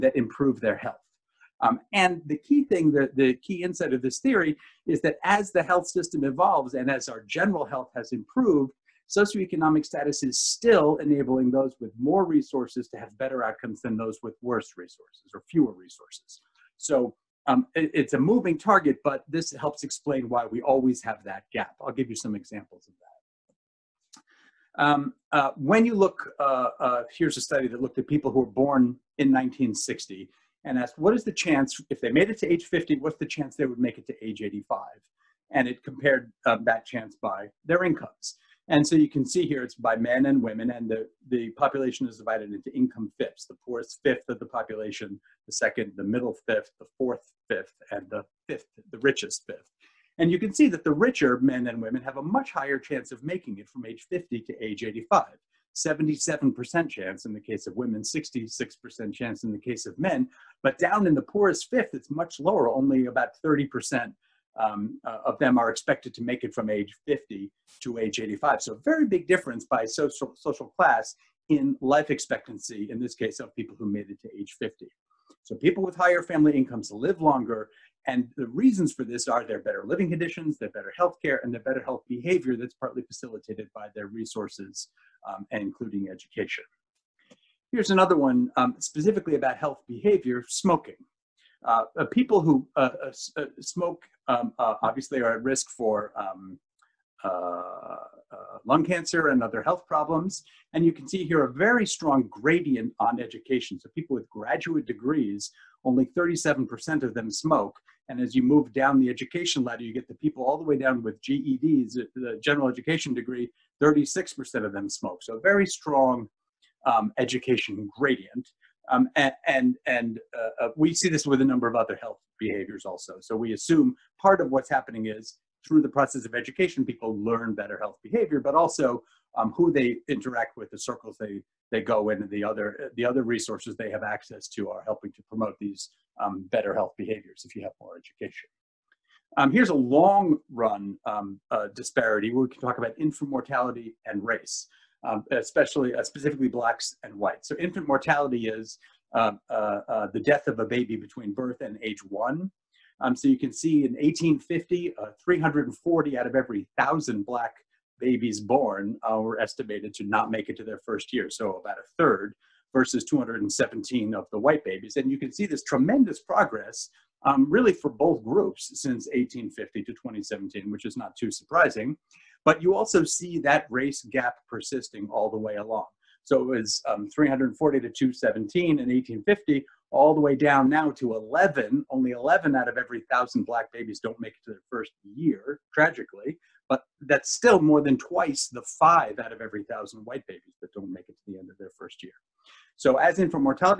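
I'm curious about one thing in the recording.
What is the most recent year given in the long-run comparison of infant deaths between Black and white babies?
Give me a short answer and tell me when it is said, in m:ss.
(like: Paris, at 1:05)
2017, at 2:49.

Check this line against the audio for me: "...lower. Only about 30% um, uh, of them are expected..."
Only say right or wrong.
right.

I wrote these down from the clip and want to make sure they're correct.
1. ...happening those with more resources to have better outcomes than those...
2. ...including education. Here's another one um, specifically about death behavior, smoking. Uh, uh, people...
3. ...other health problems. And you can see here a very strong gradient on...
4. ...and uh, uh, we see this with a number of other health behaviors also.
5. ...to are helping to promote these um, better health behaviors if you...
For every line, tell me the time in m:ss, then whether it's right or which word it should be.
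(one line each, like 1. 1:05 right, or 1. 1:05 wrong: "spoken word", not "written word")
1. 0:10 wrong: "enabling", not "happening"
2. 1:25 wrong: "health", not "death"
3. 1:39 right
4. 1:59 right
5. 2:14 right.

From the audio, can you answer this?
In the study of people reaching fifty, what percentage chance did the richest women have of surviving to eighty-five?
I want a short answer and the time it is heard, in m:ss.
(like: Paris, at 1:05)
77%, at 0:55.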